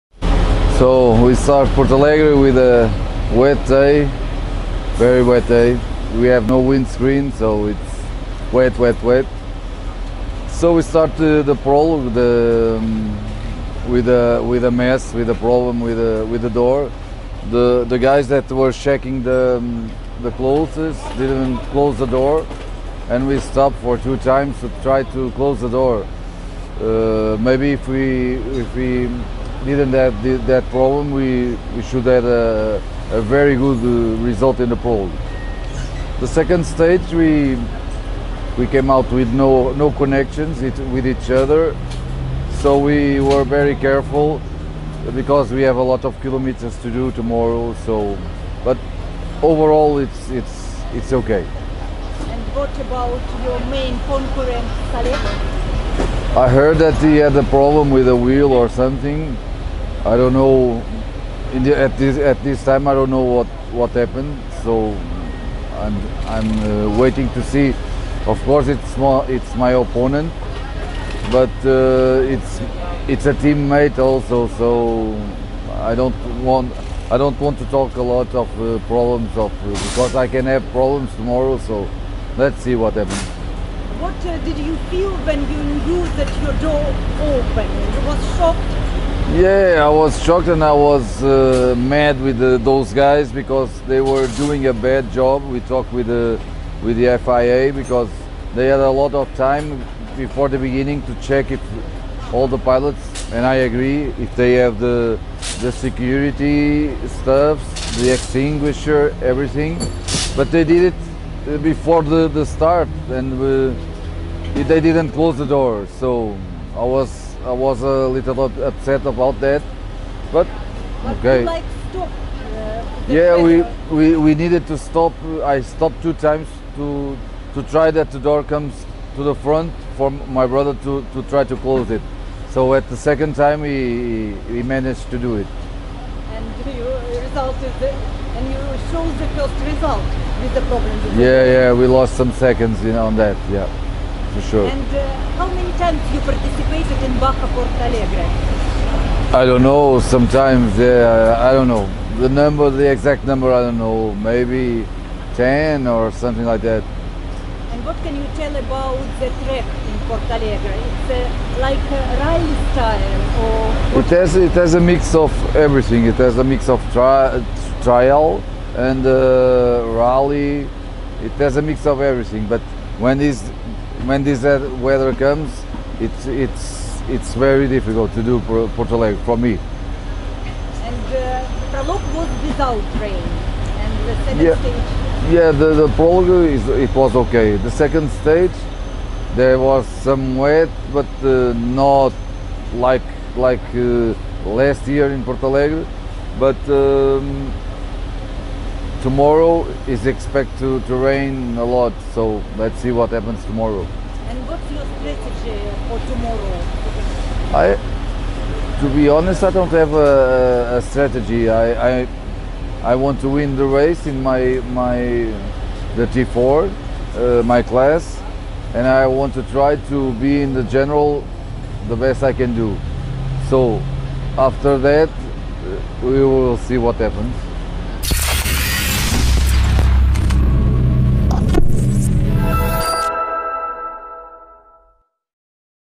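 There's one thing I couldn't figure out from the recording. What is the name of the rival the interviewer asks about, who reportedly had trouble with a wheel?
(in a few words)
Saleh.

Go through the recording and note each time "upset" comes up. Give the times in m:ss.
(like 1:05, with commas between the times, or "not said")
1:58.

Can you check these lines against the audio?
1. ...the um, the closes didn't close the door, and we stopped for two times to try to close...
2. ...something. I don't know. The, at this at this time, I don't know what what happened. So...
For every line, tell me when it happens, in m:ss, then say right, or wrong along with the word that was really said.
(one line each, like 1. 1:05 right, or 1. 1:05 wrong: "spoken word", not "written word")
1. 0:19 right
2. 0:58 right.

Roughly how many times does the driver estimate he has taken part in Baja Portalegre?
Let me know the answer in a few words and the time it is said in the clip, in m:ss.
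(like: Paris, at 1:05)
10, at 2:35.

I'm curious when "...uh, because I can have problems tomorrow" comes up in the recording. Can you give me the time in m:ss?
1:19.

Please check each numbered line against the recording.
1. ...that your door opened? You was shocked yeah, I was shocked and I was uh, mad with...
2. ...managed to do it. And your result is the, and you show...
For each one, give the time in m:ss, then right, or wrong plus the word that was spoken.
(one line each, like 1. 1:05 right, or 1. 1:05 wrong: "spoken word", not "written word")
1. 1:26 right
2. 2:14 right.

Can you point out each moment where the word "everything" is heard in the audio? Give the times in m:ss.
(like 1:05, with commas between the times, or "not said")
1:49, 2:45, 2:52.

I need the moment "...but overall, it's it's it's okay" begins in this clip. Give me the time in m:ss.
0:48.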